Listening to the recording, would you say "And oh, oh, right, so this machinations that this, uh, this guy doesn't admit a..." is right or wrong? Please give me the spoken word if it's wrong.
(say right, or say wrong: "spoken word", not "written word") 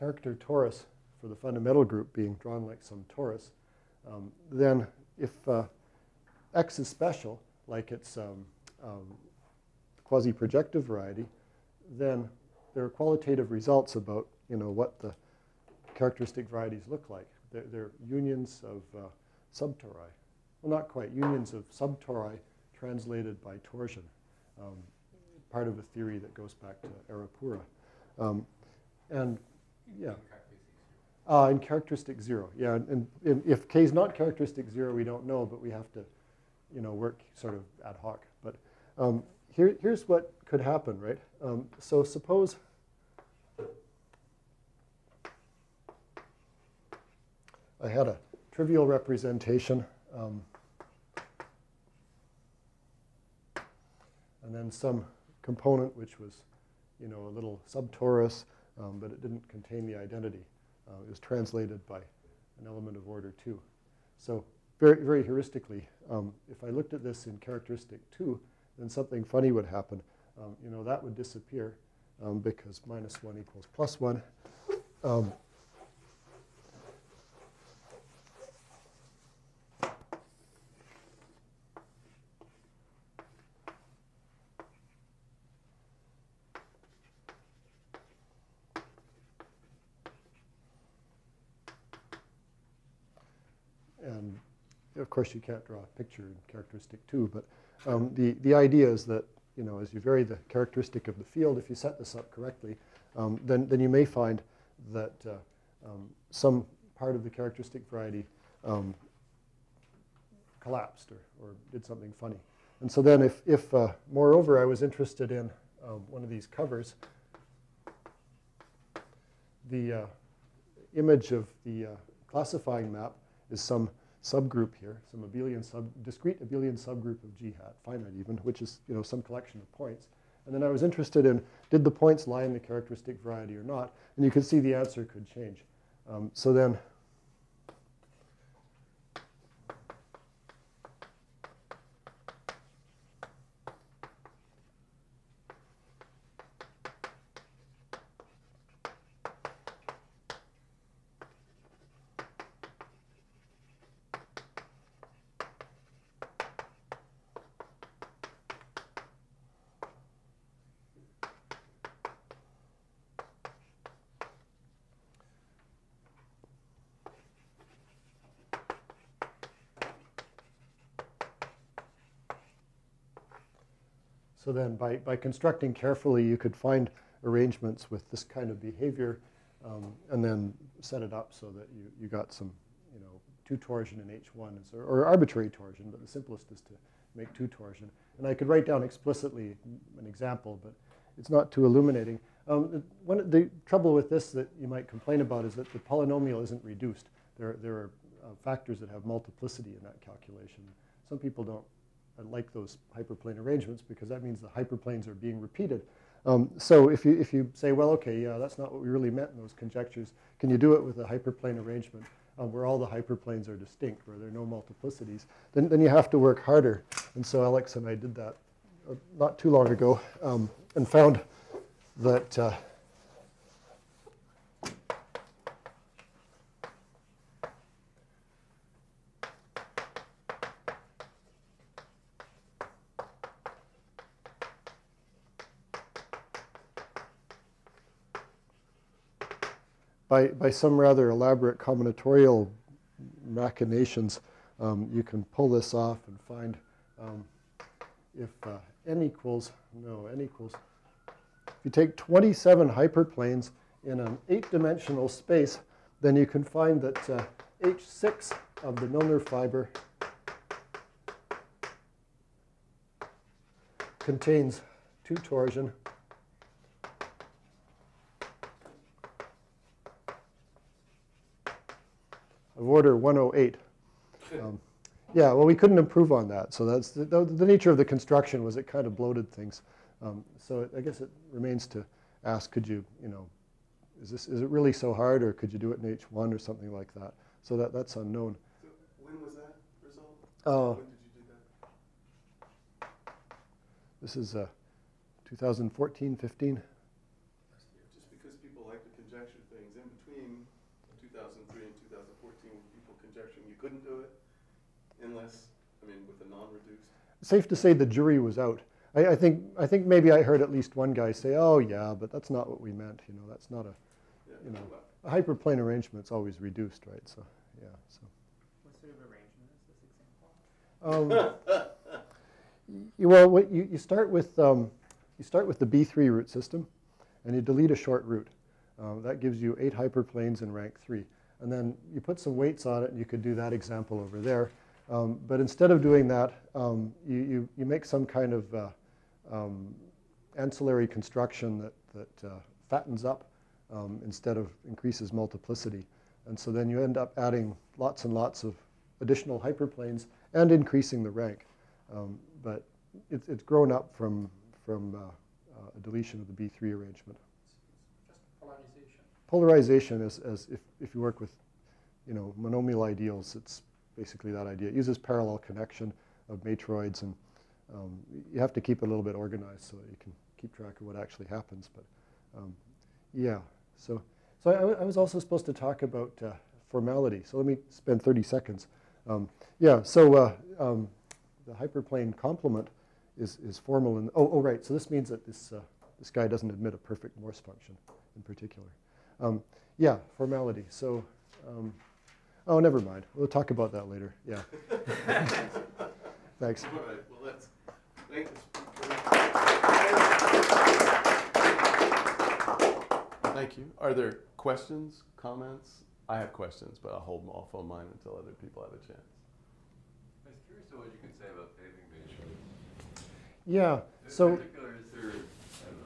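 wrong: "means", not "machinations".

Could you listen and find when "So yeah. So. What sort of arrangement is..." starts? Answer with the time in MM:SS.
05:17.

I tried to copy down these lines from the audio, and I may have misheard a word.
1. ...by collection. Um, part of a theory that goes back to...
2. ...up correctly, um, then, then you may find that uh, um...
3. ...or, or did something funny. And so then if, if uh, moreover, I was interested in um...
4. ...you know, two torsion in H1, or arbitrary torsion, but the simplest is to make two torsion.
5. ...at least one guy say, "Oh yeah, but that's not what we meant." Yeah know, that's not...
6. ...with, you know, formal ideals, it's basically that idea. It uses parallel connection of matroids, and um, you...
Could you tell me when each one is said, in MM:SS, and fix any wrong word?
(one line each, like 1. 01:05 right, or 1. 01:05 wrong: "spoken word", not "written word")
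1. 00:23 wrong: "torsion", not "collection"
2. 01:42 right
3. 01:51 right
4. 03:02 right
5. 05:10 wrong: "You", not "Yeah"
6. 06:01 wrong: "monomial", not "formal".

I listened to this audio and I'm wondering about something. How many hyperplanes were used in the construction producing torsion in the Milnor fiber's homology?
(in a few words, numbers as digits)
27.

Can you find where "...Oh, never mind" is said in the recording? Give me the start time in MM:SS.
06:32.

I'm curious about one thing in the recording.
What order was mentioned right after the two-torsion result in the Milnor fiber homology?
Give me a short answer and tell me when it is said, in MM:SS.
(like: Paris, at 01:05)
108, at 04:32.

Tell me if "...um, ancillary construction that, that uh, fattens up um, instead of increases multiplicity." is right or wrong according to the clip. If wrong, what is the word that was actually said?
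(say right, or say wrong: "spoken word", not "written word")
right.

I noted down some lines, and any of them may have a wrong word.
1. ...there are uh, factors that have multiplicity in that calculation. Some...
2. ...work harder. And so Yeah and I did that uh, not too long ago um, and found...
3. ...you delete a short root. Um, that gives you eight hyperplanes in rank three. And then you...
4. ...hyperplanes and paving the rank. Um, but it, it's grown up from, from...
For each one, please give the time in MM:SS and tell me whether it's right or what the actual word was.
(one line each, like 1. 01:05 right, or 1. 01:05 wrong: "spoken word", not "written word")
1. 03:17 right
2. 03:36 wrong: "Alex", not "Yeah"
3. 05:27 right
4. 05:49 wrong: "increasing", not "paving".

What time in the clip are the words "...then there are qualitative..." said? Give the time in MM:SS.
00:11.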